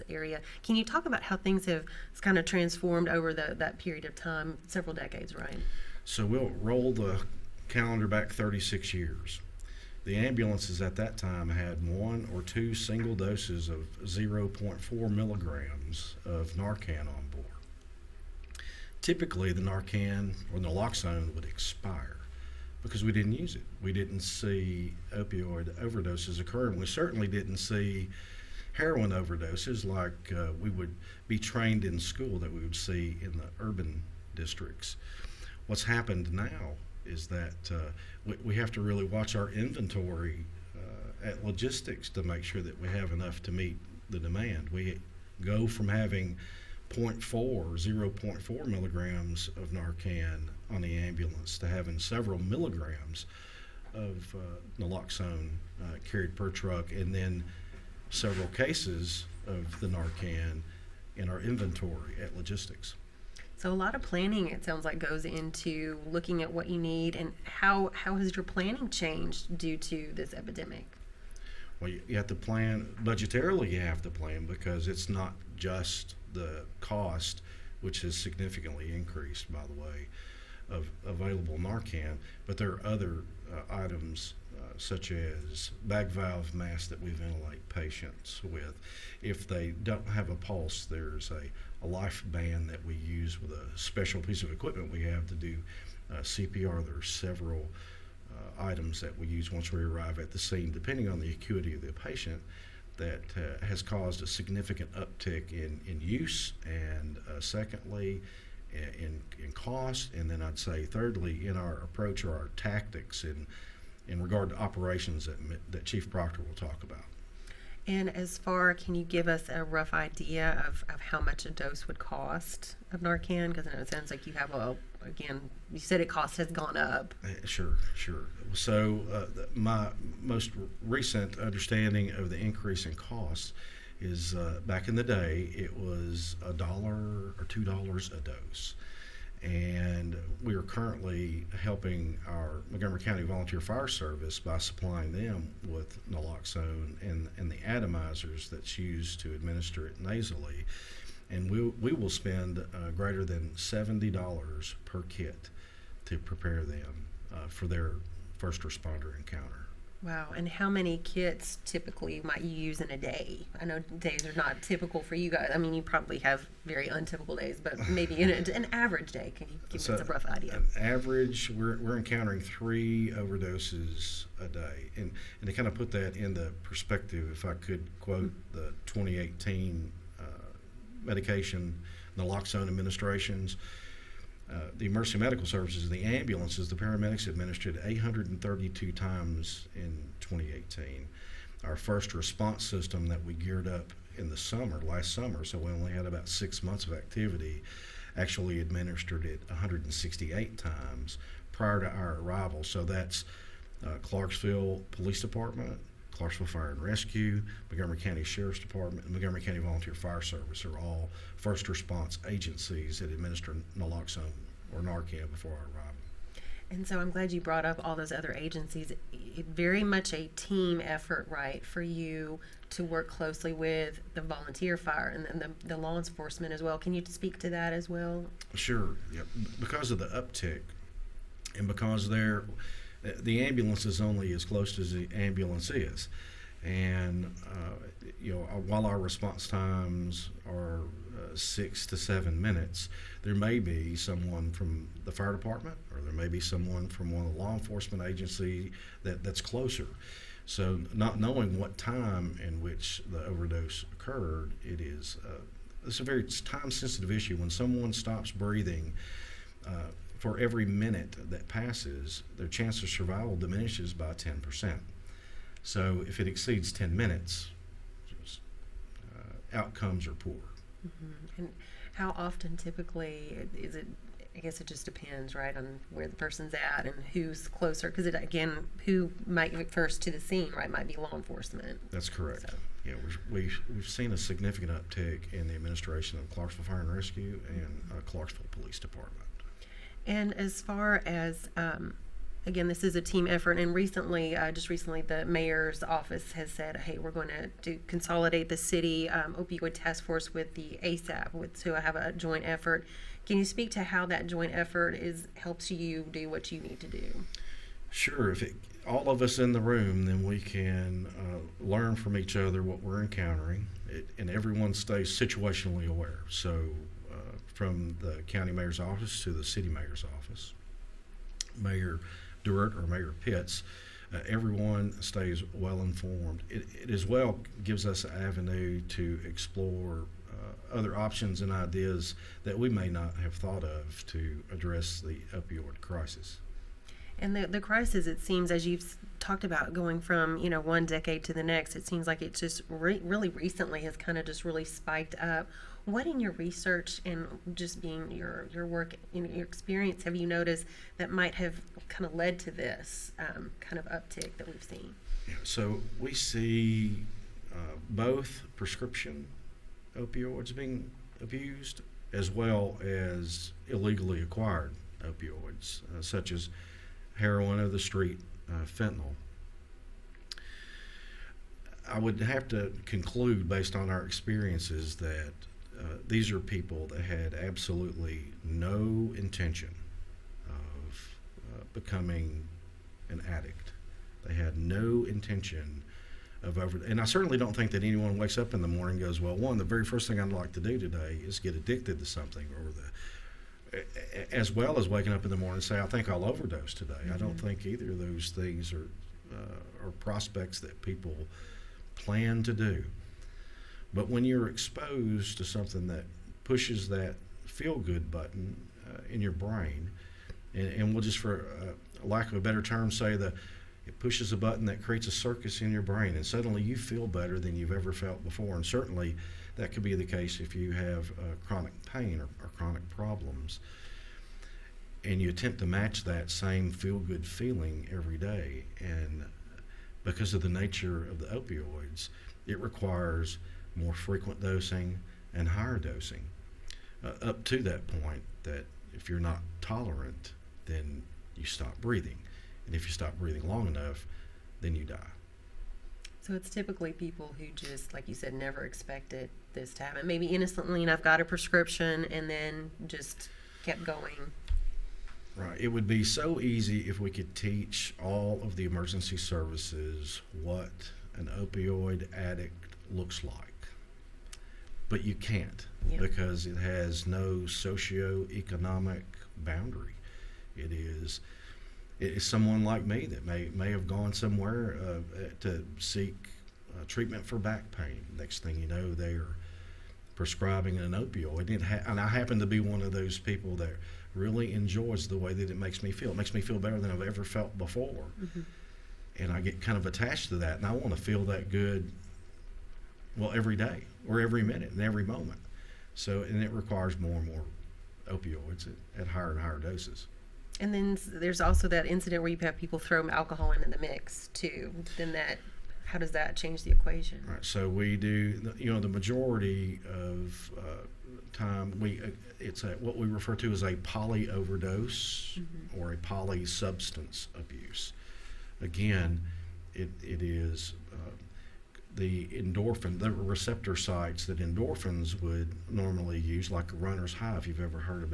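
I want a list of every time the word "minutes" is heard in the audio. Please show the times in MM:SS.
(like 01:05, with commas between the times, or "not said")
04:02, 04:20, 04:26, 08:14.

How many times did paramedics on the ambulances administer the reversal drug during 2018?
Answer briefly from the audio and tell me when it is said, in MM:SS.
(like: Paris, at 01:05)
832, at 03:07.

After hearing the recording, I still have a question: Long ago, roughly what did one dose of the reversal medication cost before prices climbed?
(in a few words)
a dollar or two.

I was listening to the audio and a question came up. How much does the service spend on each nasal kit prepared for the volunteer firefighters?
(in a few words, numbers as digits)
greater than $70.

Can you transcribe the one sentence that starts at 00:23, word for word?
We didn't see opioid overdoses occurring.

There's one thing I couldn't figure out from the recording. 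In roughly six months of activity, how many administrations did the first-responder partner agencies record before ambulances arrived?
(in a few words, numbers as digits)
168.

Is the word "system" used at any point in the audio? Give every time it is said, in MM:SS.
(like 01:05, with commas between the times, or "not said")
03:12.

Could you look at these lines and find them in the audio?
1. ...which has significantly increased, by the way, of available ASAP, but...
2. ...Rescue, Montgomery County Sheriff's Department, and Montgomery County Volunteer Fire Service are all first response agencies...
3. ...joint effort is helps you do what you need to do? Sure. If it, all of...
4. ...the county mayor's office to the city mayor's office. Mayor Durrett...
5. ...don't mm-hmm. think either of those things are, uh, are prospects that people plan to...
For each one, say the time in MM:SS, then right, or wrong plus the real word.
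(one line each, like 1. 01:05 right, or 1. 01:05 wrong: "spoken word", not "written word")
1. 01:17 wrong: "Narcan", not "ASAP"
2. 03:26 right
3. 05:04 right
4. 05:18 right
5. 06:37 right.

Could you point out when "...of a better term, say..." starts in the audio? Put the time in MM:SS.
06:52.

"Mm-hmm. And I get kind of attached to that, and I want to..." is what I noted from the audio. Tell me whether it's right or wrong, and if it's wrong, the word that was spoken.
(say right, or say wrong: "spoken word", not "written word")
right.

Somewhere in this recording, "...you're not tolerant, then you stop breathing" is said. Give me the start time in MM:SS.
07:19.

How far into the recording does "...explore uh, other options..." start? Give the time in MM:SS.
05:29.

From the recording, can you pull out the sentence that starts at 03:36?
And so I'm glad you brought up all those other agencies.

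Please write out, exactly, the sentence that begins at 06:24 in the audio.
They had no intention of over.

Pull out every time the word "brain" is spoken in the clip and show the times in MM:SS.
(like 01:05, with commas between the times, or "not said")
06:49, 06:55.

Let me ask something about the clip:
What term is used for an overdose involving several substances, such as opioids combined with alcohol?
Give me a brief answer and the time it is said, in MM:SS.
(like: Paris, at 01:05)
poly overdose, at 08:33.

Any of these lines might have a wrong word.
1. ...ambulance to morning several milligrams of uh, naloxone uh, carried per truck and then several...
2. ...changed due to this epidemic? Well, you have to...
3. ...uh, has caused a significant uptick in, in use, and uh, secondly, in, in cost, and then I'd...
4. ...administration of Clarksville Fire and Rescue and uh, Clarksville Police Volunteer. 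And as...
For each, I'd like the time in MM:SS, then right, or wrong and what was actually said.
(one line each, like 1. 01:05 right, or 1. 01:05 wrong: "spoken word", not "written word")
1. 00:50 wrong: "having", not "morning"
2. 01:08 right
3. 01:43 right
4. 04:45 wrong: "Department", not "Volunteer".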